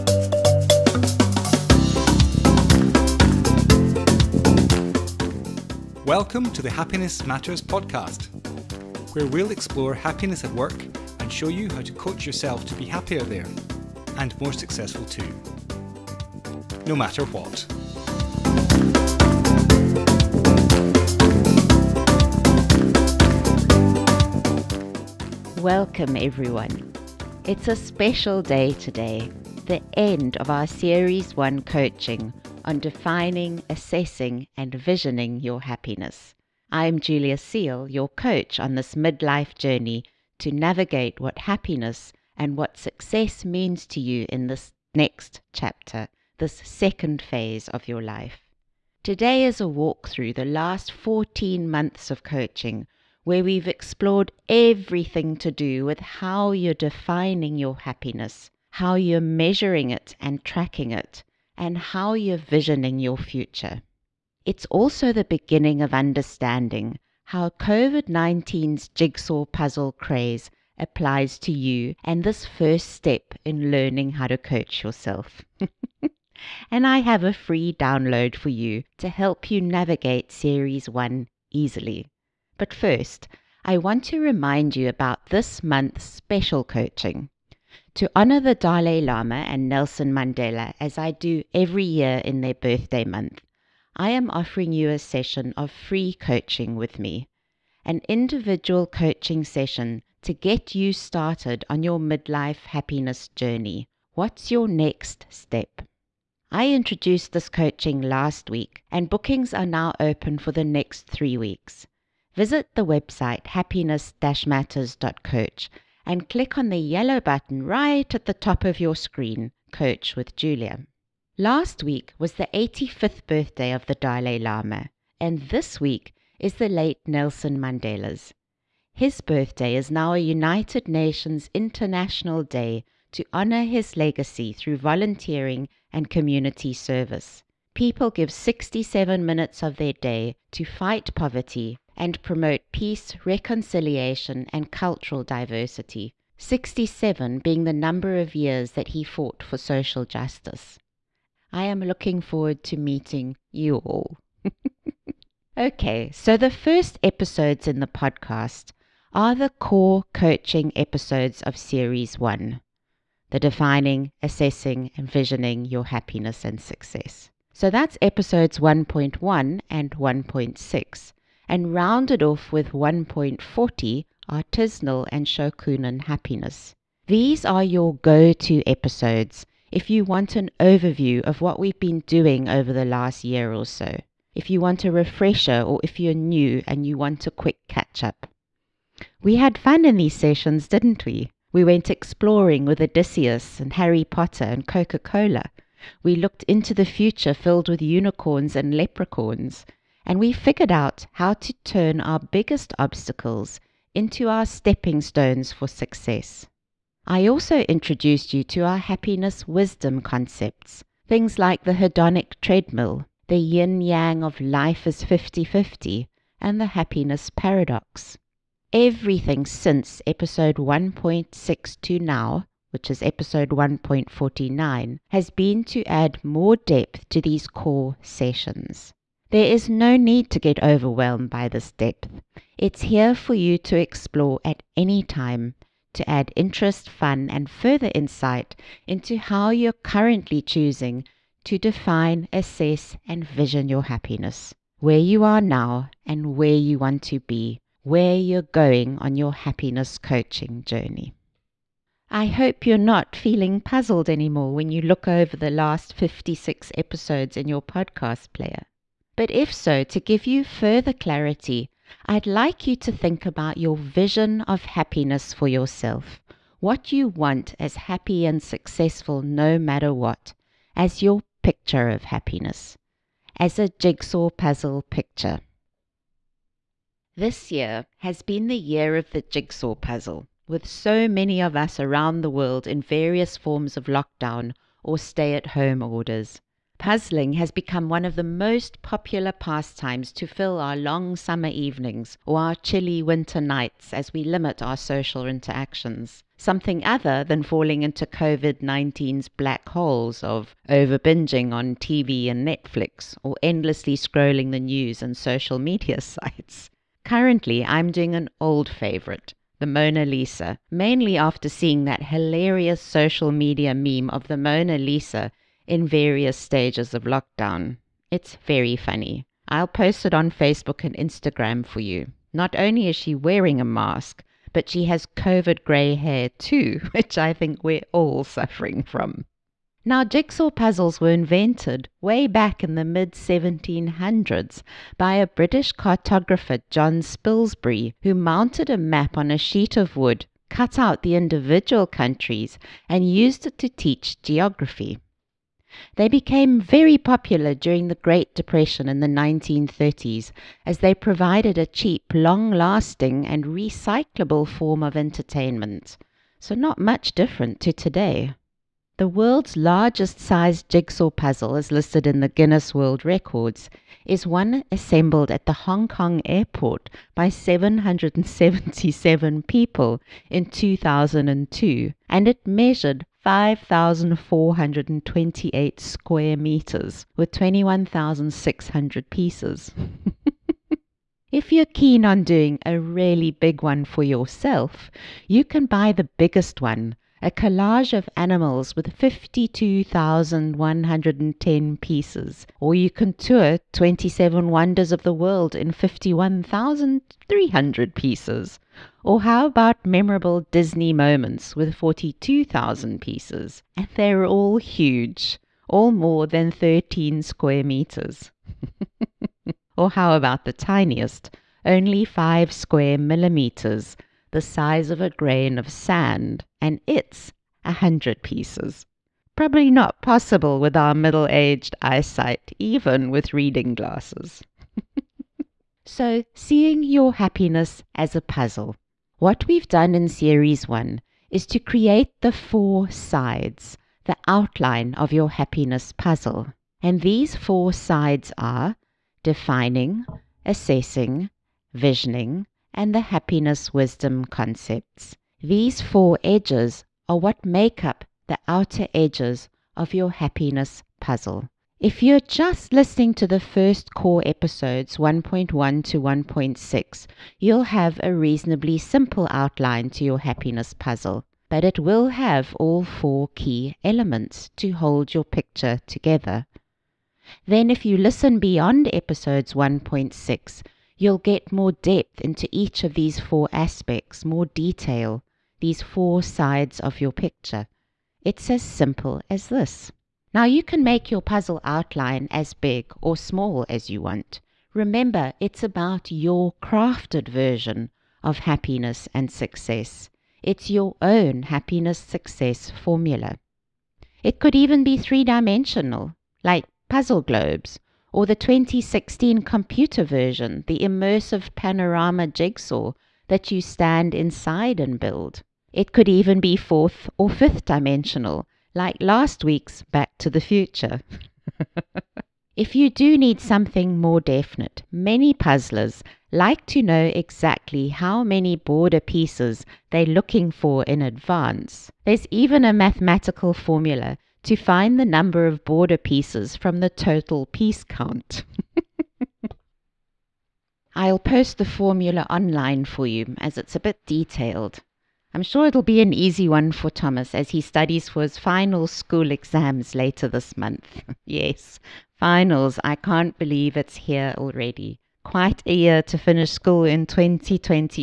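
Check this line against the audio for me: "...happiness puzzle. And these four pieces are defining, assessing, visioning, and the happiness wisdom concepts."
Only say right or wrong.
wrong.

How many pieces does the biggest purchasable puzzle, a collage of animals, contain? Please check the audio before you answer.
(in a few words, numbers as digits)
52,110.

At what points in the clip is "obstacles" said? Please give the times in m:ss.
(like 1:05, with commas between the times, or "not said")
3:22.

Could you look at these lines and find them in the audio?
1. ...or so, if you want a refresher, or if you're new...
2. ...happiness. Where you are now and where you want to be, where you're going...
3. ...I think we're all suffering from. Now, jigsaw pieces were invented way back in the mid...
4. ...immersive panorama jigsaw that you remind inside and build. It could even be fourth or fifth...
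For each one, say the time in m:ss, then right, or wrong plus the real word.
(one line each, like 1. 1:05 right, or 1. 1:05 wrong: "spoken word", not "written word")
1. 3:03 right
2. 4:03 right
3. 5:27 wrong: "puzzles", not "pieces"
4. 8:20 wrong: "stand", not "remind".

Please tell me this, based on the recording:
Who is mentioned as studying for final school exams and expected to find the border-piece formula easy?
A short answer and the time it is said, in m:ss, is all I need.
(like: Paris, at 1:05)
Thomas, at 8:56.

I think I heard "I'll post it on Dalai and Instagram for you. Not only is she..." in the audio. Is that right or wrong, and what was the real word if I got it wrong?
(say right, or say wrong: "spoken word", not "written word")
wrong: "Facebook", not "Dalai".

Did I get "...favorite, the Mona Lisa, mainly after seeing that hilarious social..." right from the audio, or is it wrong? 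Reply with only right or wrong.
right.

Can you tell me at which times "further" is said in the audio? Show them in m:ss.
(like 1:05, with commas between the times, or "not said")
3:57, 4:20.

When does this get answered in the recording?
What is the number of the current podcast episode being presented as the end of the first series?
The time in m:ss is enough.
3:43.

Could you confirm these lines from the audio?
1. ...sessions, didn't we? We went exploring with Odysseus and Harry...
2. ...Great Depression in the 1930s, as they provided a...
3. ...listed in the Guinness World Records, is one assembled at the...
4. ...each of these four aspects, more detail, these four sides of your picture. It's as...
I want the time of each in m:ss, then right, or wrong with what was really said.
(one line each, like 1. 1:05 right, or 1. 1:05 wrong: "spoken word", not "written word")
1. 3:10 right
2. 5:47 right
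3. 6:01 right
4. 7:52 right.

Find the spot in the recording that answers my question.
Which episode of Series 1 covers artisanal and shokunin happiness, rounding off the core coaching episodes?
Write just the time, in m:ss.
2:52.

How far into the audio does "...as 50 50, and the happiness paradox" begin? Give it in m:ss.
3:34.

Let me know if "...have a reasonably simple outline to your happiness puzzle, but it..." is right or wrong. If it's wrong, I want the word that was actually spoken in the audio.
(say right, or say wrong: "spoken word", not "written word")
right.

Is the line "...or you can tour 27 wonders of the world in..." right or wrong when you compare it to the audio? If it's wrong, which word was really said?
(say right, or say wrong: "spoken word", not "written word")
right.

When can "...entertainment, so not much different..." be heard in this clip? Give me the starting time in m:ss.
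5:54.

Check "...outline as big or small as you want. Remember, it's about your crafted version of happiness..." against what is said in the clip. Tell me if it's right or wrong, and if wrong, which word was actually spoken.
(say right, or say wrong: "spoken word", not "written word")
right.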